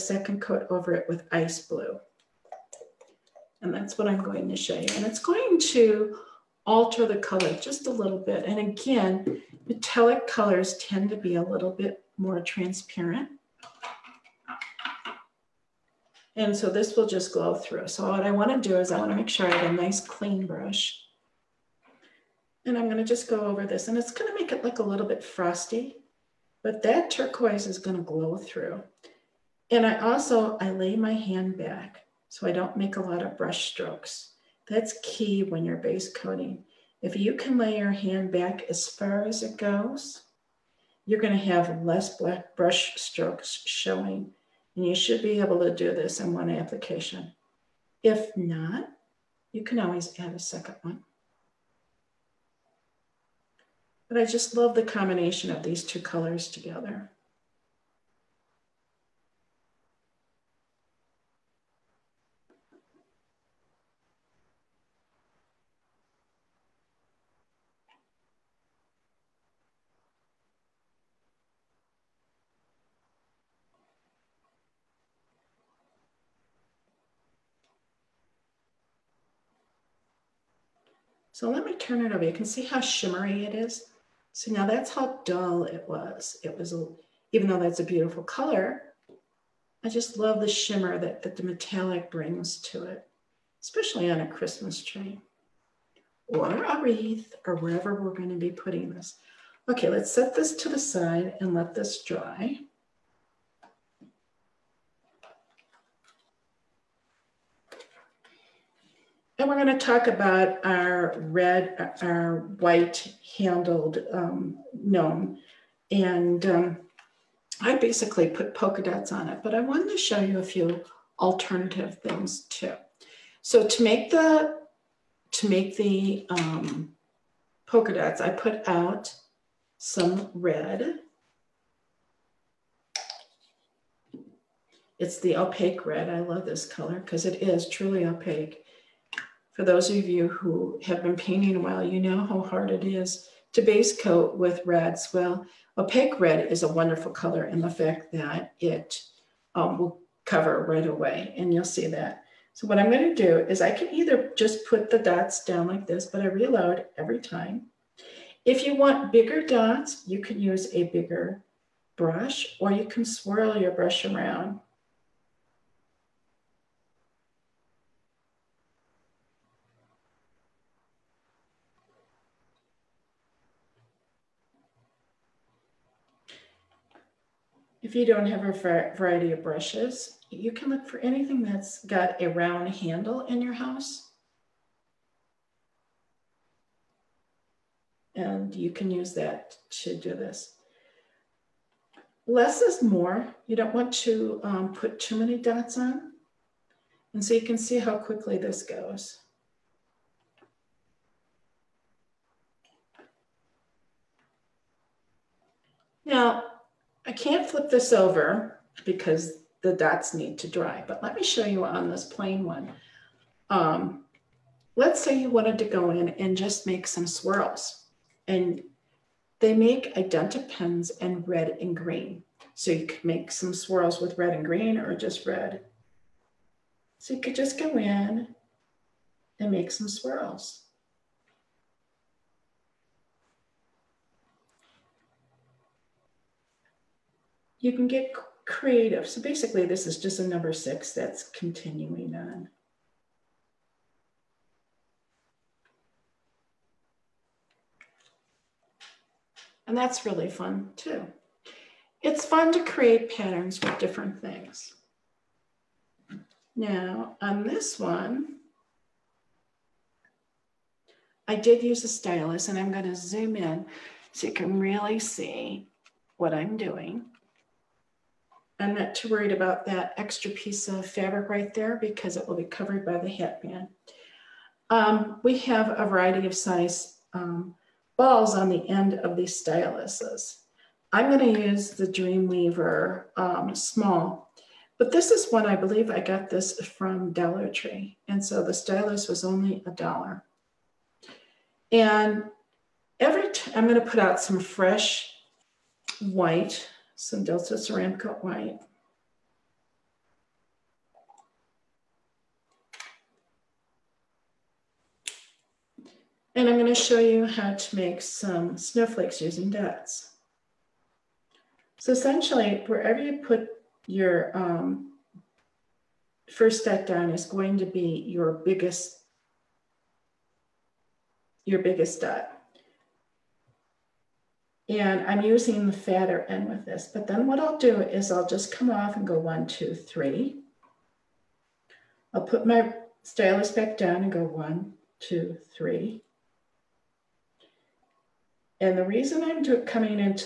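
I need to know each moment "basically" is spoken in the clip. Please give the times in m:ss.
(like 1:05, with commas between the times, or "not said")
1:57, 3:59.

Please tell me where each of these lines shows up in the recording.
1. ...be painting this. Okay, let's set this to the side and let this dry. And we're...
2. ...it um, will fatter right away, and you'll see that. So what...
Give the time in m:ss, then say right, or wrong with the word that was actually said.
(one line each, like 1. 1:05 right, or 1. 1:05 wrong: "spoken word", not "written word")
1. 1:38 wrong: "putting", not "painting"
2. 2:28 wrong: "cover", not "fatter".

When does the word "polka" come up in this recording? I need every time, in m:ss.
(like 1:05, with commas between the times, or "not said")
1:58, 2:07.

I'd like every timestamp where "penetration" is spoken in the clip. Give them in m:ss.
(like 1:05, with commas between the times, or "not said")
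not said.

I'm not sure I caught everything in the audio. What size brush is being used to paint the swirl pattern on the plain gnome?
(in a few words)
6.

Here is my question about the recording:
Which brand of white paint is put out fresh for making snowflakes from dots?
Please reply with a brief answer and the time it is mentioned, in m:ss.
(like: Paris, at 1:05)
Delta Ceramcoat, at 4:57.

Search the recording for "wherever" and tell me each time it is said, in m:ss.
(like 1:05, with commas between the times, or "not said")
1:37, 5:12.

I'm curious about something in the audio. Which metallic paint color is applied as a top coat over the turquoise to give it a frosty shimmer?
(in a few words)
Ice blue.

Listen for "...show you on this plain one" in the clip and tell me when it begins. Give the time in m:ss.
3:31.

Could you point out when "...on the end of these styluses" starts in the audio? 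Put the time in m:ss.
4:38.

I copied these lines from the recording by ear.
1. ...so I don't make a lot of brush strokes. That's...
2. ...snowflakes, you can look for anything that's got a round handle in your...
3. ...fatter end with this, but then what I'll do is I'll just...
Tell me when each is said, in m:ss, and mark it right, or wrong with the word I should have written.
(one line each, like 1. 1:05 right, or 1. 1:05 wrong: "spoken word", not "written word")
1. 0:32 right
2. 2:59 wrong: "brushes", not "snowflakes"
3. 5:25 right.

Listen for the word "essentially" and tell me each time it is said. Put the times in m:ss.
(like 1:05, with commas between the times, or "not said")
5:11.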